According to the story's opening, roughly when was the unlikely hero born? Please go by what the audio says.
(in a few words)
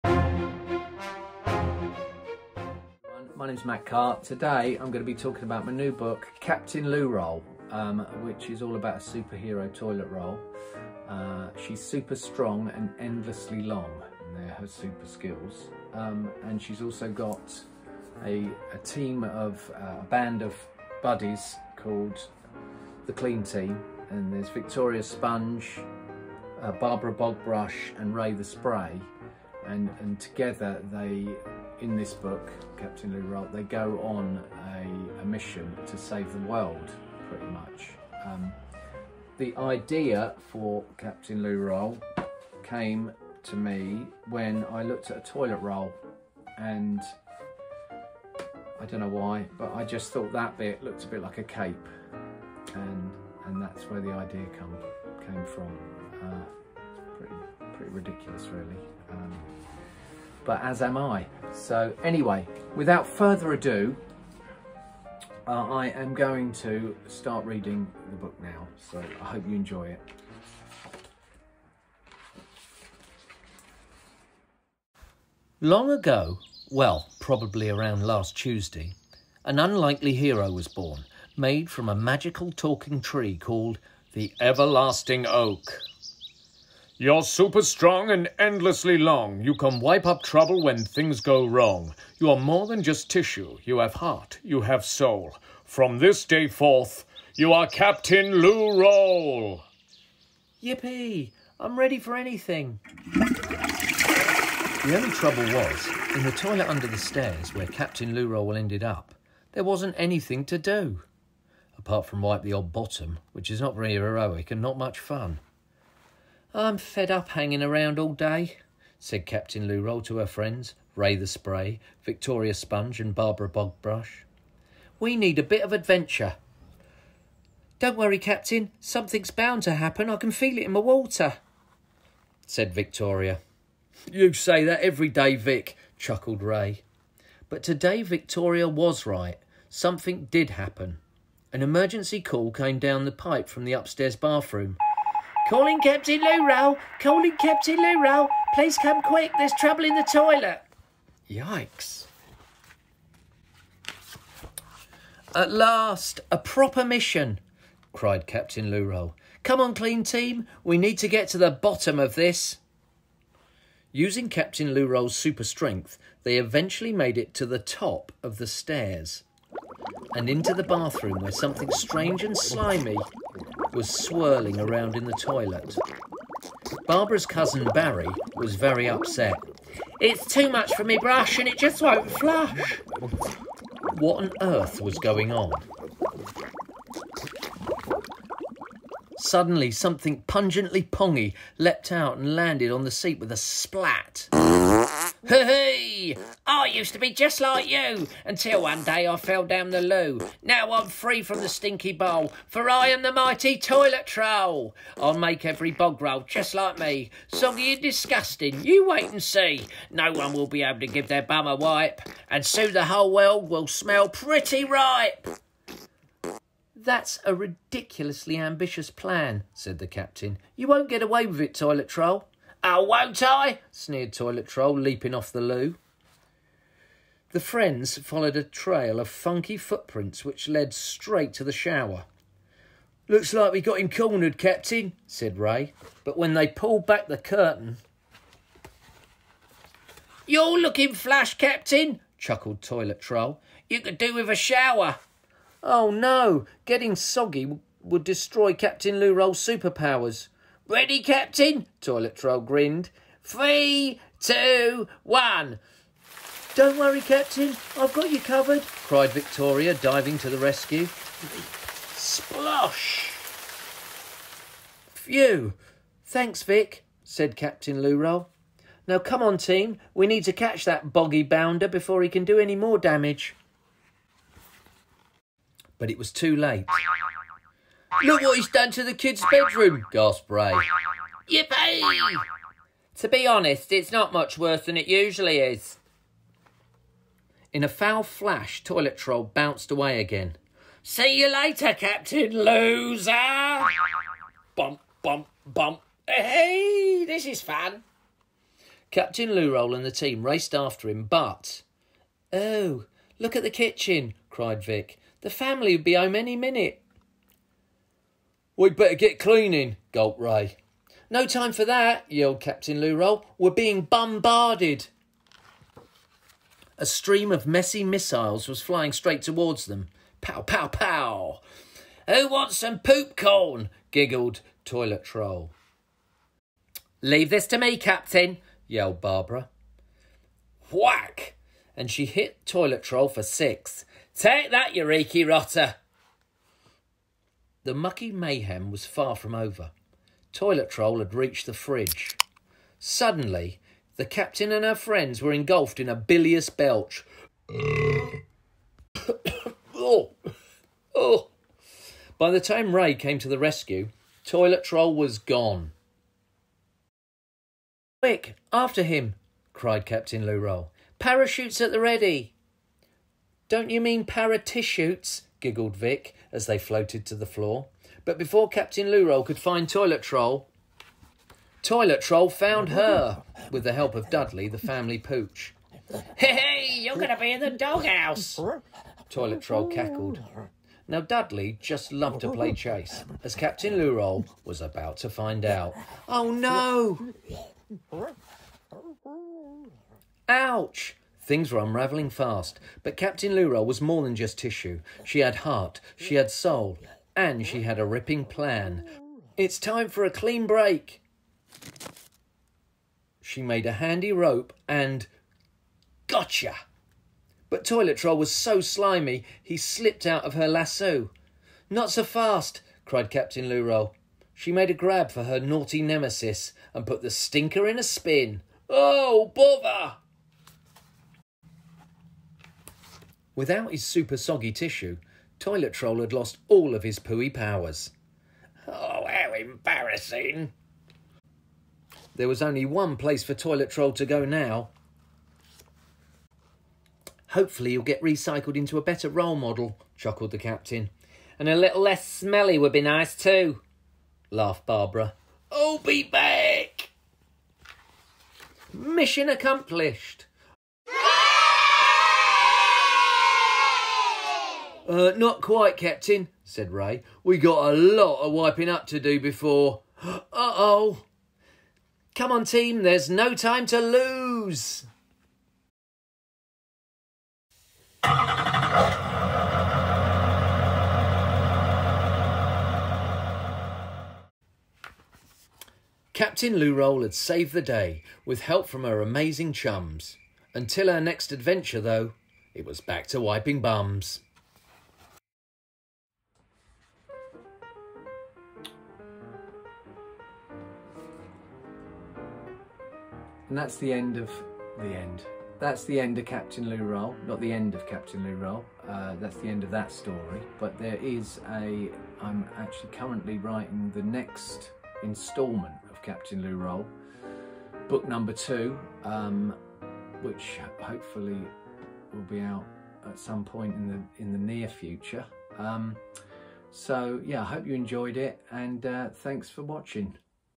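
Last Tuesday.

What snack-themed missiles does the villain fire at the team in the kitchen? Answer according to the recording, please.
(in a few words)
Poop corn.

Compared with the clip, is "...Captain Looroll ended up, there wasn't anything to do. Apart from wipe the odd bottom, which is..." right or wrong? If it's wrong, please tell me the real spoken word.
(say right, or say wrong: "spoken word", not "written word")
right.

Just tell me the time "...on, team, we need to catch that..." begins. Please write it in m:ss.
4:29.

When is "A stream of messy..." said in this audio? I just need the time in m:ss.
5:16.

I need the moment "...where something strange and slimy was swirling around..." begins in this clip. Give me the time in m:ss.
2:51.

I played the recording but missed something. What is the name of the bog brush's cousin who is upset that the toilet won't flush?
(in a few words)
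Barry.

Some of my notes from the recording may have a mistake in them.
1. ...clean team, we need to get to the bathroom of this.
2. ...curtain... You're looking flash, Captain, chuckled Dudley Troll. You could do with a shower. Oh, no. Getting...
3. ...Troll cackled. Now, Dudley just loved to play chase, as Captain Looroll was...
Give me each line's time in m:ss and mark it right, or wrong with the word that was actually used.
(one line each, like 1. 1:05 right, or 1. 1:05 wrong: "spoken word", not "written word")
1. 2:39 wrong: "bottom", not "bathroom"
2. 3:57 wrong: "Toilet", not "Dudley"
3. 6:19 right.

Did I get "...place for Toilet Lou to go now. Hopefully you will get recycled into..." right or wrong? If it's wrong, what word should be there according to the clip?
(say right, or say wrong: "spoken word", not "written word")
wrong: "Troll", not "Lou".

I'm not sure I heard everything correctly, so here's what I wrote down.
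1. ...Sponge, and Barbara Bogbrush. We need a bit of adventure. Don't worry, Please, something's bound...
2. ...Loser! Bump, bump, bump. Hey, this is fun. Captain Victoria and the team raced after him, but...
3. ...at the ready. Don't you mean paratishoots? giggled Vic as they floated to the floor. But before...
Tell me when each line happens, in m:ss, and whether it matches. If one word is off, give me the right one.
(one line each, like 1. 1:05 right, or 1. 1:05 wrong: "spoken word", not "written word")
1. 2:02 wrong: "Captain", not "Please"
2. 4:52 wrong: "Roll", not "Victoria"
3. 6:01 right.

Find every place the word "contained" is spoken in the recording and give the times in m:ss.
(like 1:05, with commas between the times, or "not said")
not said.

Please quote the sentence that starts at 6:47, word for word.
But Toilet Troll was so slimy, he slipped out of her lasso.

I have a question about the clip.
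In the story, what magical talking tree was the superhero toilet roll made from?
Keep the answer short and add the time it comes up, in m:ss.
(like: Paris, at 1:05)
Everlasting Oak, at 1:24.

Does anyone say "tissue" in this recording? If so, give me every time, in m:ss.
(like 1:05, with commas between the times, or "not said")
1:33, 6:34, 7:04.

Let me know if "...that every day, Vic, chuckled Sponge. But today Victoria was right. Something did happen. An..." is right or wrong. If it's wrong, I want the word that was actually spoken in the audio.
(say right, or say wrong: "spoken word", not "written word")
wrong: "Ray", not "Sponge".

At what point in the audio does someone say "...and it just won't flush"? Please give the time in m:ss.
3:01.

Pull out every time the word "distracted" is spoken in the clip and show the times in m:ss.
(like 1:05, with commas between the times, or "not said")
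not said.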